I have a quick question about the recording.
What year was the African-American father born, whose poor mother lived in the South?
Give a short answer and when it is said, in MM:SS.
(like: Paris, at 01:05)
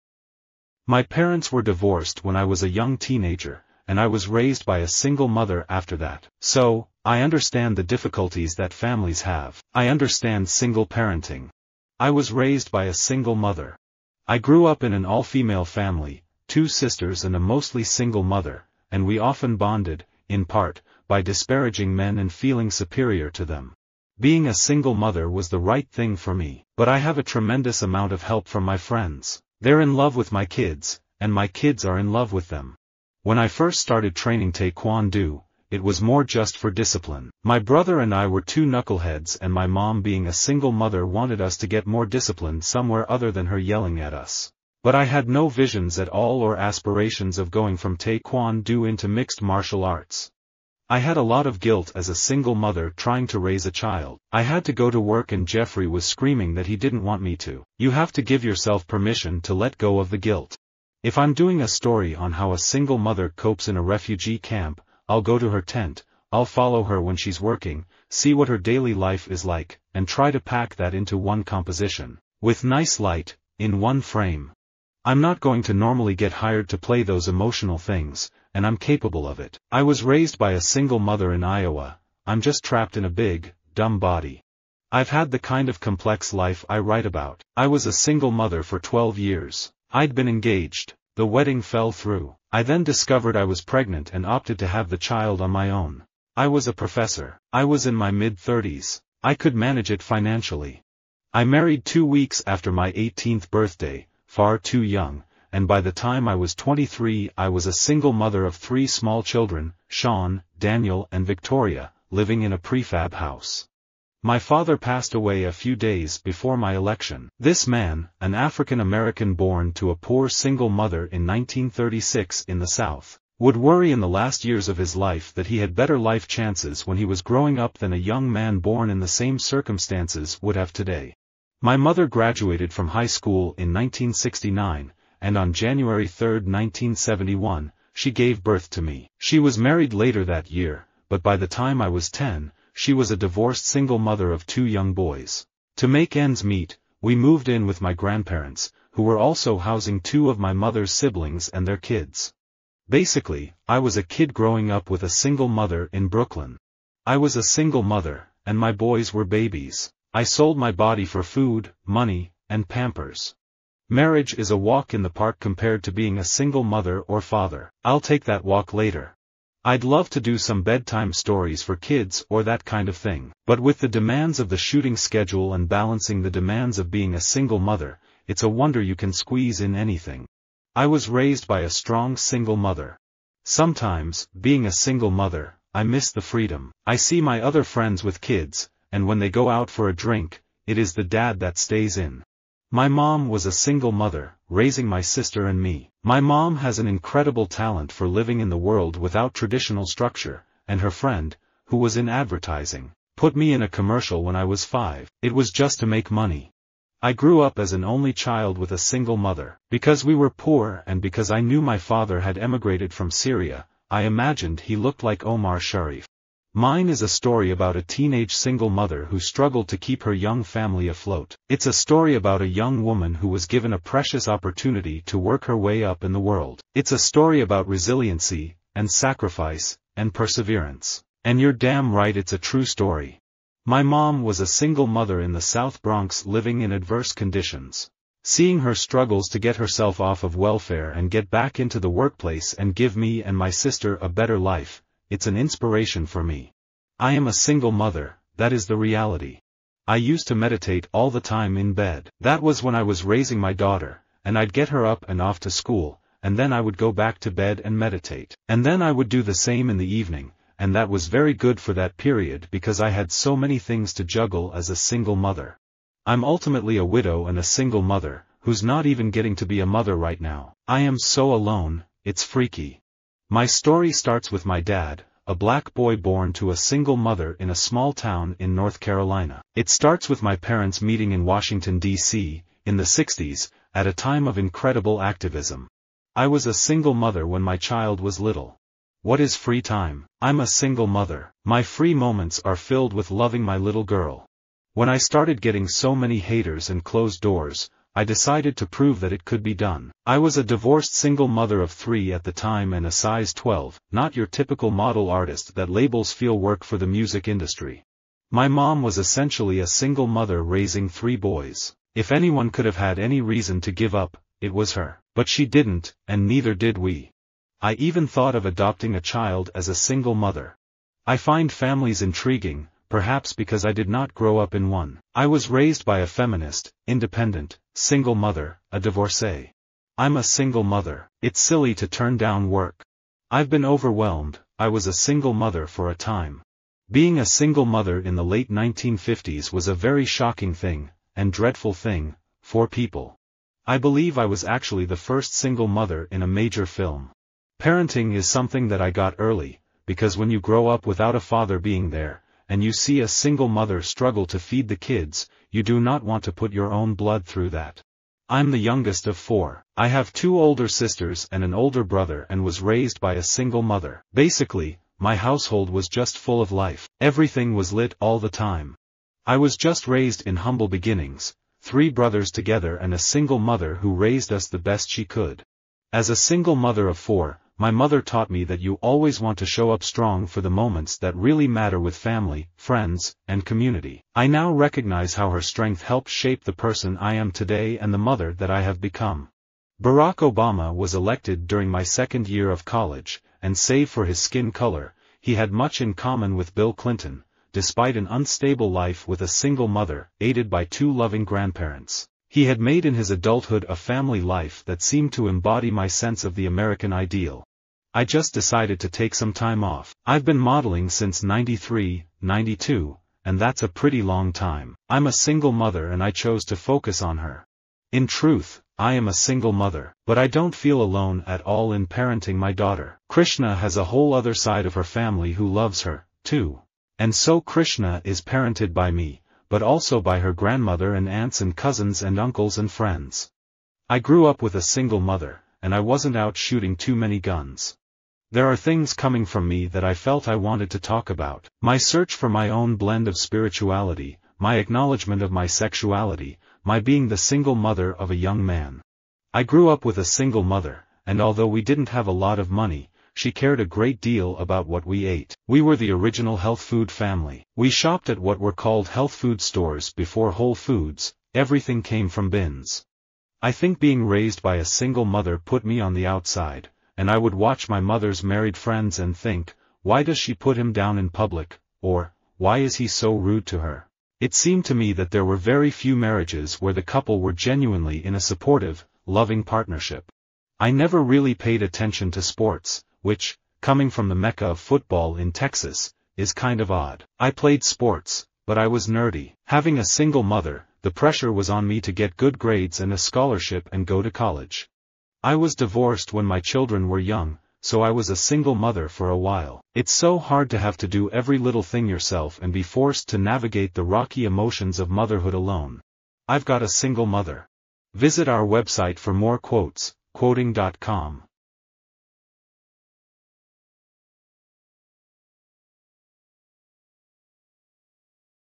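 1936, at 02:01.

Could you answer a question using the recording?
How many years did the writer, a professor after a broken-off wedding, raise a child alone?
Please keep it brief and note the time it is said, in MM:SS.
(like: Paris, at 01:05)
12, at 01:28.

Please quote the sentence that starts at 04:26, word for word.
I'm ultimately a widow and a single mother, who's not even getting to be a mother right now.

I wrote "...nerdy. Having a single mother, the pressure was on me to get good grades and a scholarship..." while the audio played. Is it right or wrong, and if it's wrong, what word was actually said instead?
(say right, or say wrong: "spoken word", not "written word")
right.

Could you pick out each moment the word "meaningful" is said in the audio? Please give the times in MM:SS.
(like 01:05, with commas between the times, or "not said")
not said.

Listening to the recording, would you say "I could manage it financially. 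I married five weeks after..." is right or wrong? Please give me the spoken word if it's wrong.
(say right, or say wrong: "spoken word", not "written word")
wrong: "two", not "five".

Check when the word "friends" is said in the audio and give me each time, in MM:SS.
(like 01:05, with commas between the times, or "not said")
00:28, 03:07, 03:20, 06:22, 07:12, 07:48.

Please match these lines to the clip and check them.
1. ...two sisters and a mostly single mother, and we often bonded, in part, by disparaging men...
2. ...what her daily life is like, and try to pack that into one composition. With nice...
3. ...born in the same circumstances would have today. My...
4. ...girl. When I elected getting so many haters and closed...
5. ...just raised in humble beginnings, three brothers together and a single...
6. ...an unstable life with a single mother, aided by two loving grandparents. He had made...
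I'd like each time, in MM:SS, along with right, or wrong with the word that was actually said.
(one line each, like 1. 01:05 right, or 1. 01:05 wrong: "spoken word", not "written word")
1. 00:16 right
2. 01:08 right
3. 02:08 right
4. 04:53 wrong: "started", not "elected"
5. 06:09 right
6. 06:37 right.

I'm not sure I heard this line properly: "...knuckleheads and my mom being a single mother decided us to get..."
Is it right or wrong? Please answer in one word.
wrong.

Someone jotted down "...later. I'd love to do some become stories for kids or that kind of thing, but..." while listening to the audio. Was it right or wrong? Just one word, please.
wrong.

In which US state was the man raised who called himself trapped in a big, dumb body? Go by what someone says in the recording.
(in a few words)
Iowa.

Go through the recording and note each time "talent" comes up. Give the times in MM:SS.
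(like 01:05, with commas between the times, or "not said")
03:17.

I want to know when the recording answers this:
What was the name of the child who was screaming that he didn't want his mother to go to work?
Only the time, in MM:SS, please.
00:55.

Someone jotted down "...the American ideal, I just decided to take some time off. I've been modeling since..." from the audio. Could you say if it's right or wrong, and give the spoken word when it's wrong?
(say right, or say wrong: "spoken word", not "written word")
right.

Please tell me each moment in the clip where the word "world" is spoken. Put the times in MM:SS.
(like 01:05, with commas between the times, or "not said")
03:18, 03:46.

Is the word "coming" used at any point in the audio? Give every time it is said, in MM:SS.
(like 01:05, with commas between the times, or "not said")
07:18, 08:03.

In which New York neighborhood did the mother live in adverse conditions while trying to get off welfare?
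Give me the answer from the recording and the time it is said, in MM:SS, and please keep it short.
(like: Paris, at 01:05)
South Bronx, at 03:55.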